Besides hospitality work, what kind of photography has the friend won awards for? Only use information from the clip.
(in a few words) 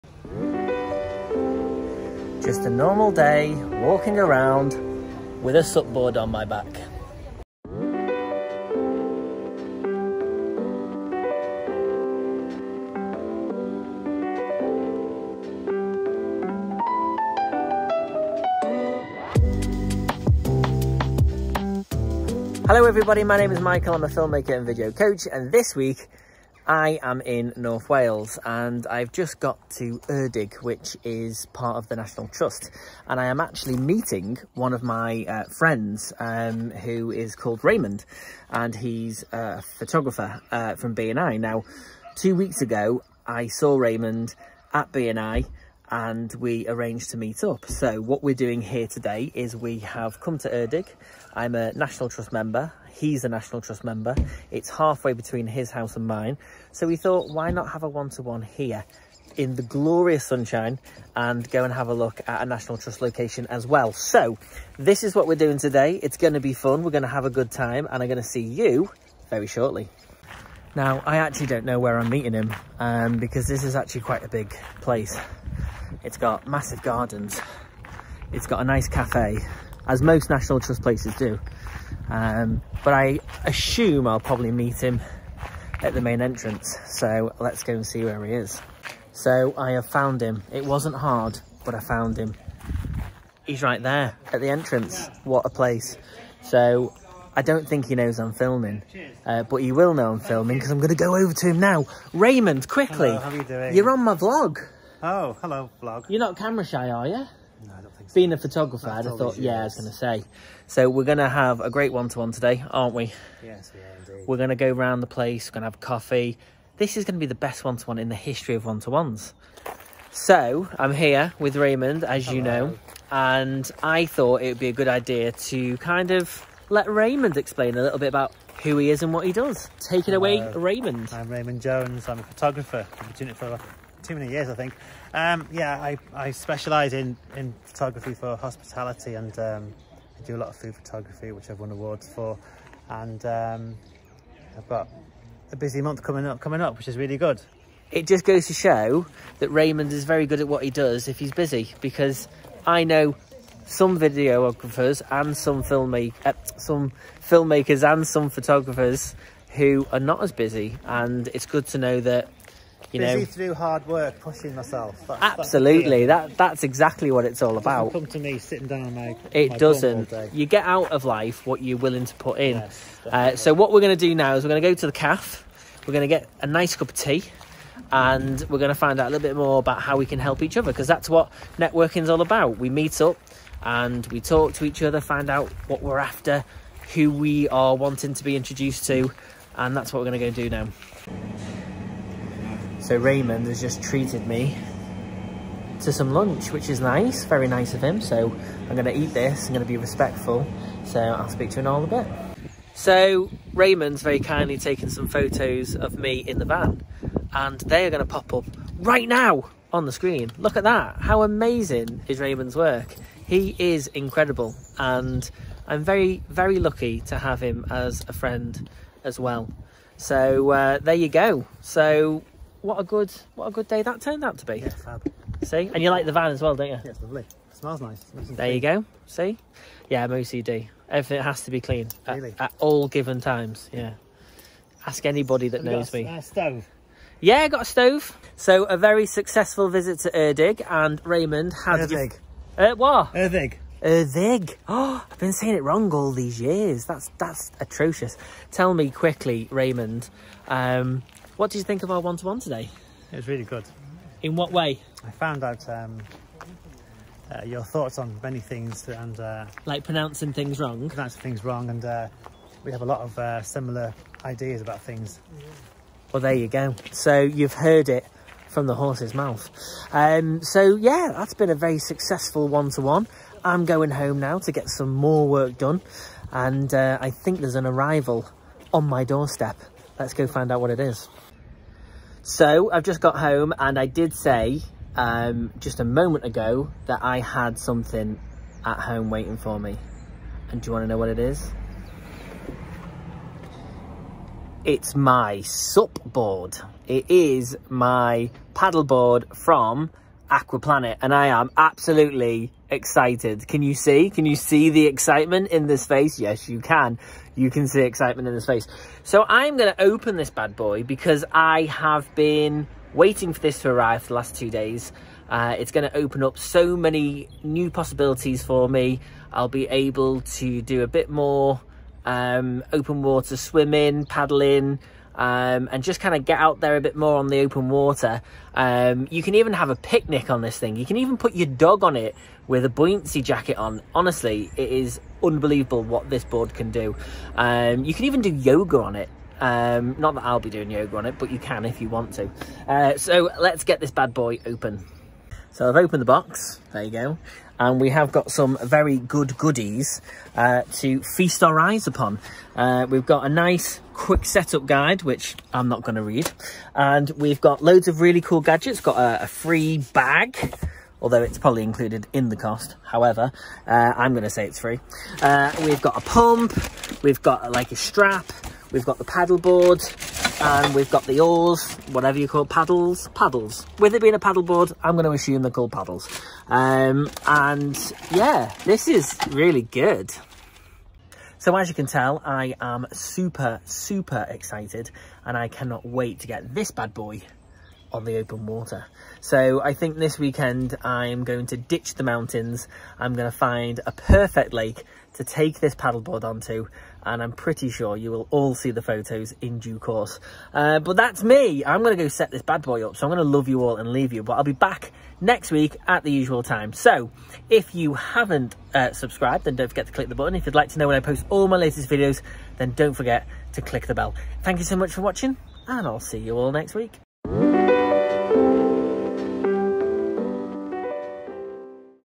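Food photography.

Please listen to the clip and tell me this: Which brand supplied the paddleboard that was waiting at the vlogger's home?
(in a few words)
Aquaplanet.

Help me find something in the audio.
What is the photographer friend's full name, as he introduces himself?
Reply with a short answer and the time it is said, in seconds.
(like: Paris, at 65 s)
Raymond Jones, at 131 s.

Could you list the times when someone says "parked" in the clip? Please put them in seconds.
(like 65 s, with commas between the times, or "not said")
not said.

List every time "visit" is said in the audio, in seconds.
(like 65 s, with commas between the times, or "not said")
239 s.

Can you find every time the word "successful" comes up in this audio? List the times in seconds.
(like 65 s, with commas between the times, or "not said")
239 s, 271 s.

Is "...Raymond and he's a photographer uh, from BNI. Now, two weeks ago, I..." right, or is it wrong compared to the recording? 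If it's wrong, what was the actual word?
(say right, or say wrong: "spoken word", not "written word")
right.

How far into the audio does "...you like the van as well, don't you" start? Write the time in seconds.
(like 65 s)
225 s.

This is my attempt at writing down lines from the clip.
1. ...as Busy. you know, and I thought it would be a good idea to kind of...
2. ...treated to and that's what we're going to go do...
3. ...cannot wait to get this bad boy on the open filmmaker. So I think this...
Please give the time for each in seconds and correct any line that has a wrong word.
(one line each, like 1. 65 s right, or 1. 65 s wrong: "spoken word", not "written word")
1. 122 s wrong: "Hello", not "Busy"
2. 188 s wrong: "introduced", not "treated"
3. 385 s wrong: "water", not "filmmaker".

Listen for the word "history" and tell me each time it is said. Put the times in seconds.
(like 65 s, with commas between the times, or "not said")
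118 s.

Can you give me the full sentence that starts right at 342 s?
Uh, so let's get this bad boy open.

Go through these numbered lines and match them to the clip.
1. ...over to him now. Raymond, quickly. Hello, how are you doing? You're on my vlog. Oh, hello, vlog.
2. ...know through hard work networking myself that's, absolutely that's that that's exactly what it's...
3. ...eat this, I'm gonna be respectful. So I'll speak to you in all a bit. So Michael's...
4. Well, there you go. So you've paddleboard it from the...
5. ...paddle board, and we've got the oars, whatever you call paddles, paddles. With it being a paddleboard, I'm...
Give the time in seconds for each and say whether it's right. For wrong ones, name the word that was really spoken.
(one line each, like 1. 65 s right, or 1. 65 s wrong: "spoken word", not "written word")
1. 101 s right
2. 163 s wrong: "pushing", not "networking"
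3. 198 s wrong: "Raymond", not "Michael"
4. 266 s wrong: "heard", not "paddleboard"
5. 369 s right.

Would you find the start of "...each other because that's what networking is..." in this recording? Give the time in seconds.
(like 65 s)
180 s.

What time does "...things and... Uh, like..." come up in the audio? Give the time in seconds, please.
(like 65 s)
258 s.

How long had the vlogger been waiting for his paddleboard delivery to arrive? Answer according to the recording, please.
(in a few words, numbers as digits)
2 days.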